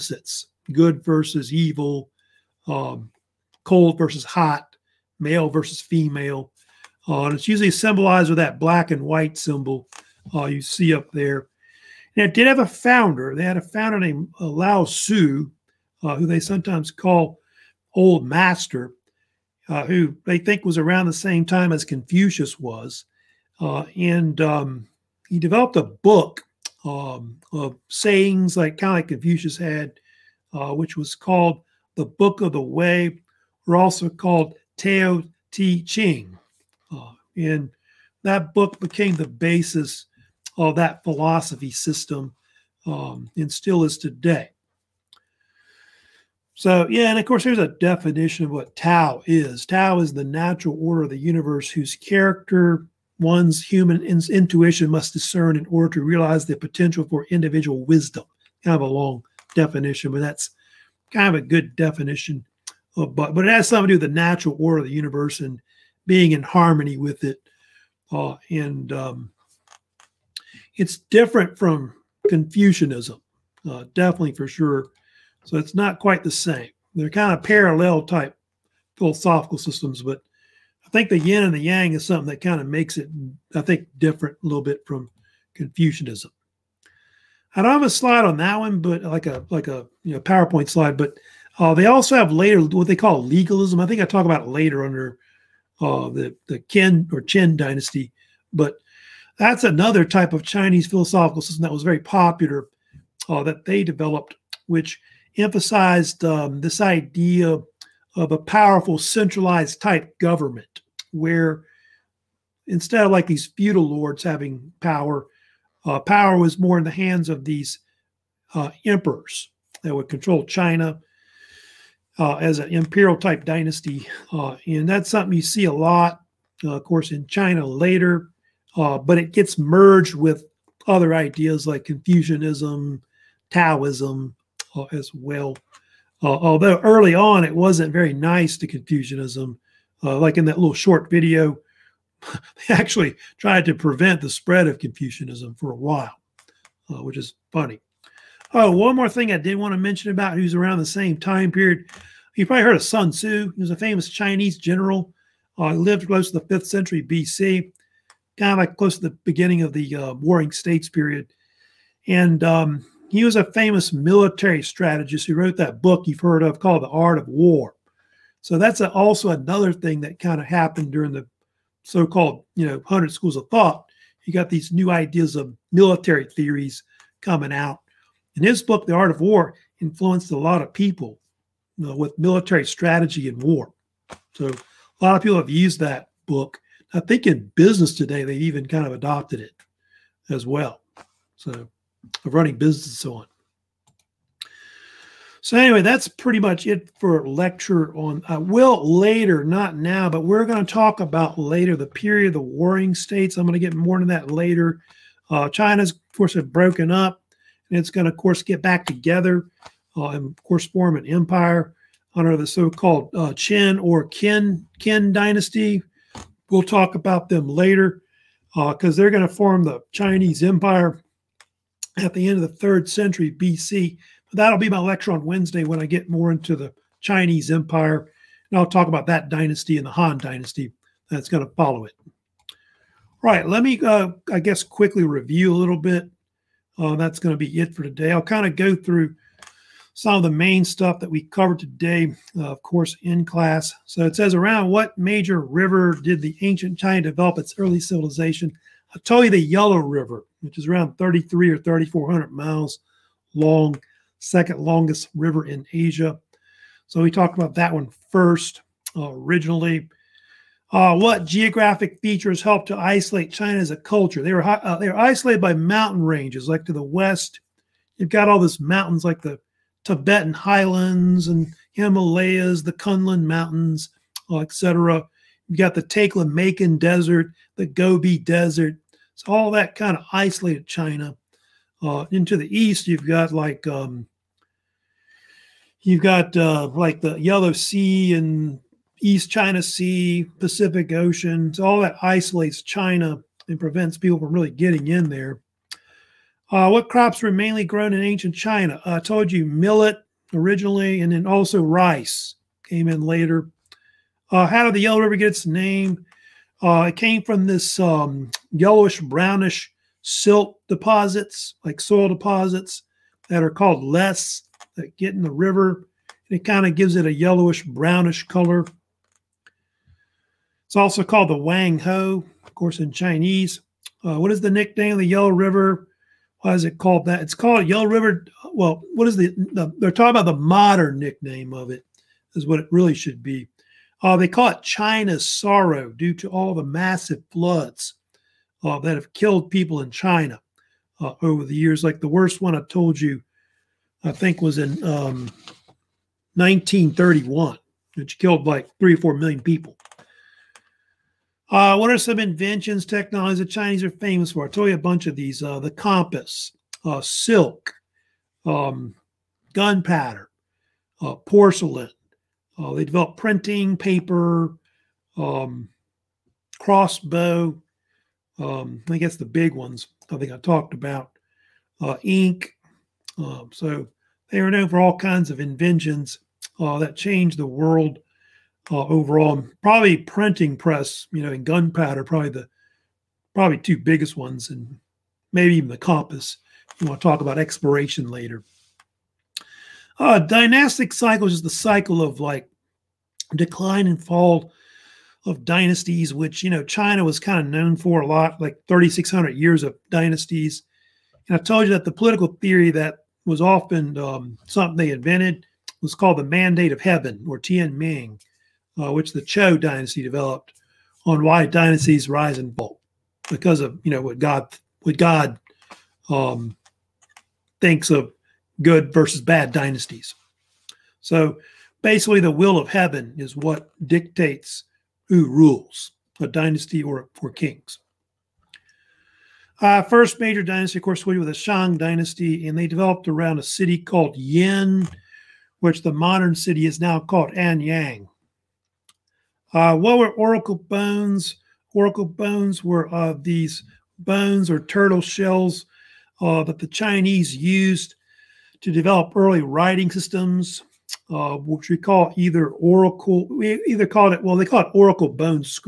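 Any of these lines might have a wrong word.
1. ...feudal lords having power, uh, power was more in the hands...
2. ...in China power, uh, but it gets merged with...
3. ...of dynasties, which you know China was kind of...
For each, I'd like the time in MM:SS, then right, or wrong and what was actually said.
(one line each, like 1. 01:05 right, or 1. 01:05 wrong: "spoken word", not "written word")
1. 01:53 right
2. 02:07 wrong: "later", not "power"
3. 06:35 right.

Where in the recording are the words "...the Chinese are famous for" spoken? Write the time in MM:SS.
05:53.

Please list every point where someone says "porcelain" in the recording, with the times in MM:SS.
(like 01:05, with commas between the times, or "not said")
06:01.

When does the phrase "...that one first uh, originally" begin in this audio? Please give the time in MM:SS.
04:17.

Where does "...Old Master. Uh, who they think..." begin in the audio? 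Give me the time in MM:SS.
00:17.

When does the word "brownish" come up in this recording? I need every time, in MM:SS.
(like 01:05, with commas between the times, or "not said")
05:09, 05:17.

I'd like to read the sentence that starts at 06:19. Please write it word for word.
Probably printing press, you know, and gunpowder, probably the probably two biggest ones, and maybe even the compass.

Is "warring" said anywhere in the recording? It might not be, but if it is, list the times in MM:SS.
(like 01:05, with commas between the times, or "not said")
02:40, 03:22.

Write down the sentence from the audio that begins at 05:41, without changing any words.
Like the worst one I told you, I think was in um, 1931, which killed like three or four million people.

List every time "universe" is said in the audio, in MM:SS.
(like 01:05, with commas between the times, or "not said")
00:51, 01:04.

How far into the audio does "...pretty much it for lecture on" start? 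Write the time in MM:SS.
03:16.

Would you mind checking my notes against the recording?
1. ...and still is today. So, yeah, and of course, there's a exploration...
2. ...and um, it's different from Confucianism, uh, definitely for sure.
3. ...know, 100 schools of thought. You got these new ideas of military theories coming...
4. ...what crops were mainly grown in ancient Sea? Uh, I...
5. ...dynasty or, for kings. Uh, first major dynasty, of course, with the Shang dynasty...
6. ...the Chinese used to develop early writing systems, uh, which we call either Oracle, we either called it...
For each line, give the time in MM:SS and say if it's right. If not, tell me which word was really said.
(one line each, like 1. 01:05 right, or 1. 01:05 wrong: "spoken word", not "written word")
1. 00:43 wrong: "definition", not "exploration"
2. 01:08 right
3. 02:52 right
4. 04:56 wrong: "China", not "Sea"
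5. 07:06 right
6. 07:26 right.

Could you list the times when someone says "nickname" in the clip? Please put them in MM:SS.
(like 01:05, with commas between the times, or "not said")
05:24, 05:30.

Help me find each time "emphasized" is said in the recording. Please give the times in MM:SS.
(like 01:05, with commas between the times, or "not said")
01:45.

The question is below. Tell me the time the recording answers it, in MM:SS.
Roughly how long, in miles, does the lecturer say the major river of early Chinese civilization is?
04:11.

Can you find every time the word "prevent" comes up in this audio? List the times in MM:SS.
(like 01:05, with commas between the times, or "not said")
02:23, 04:53.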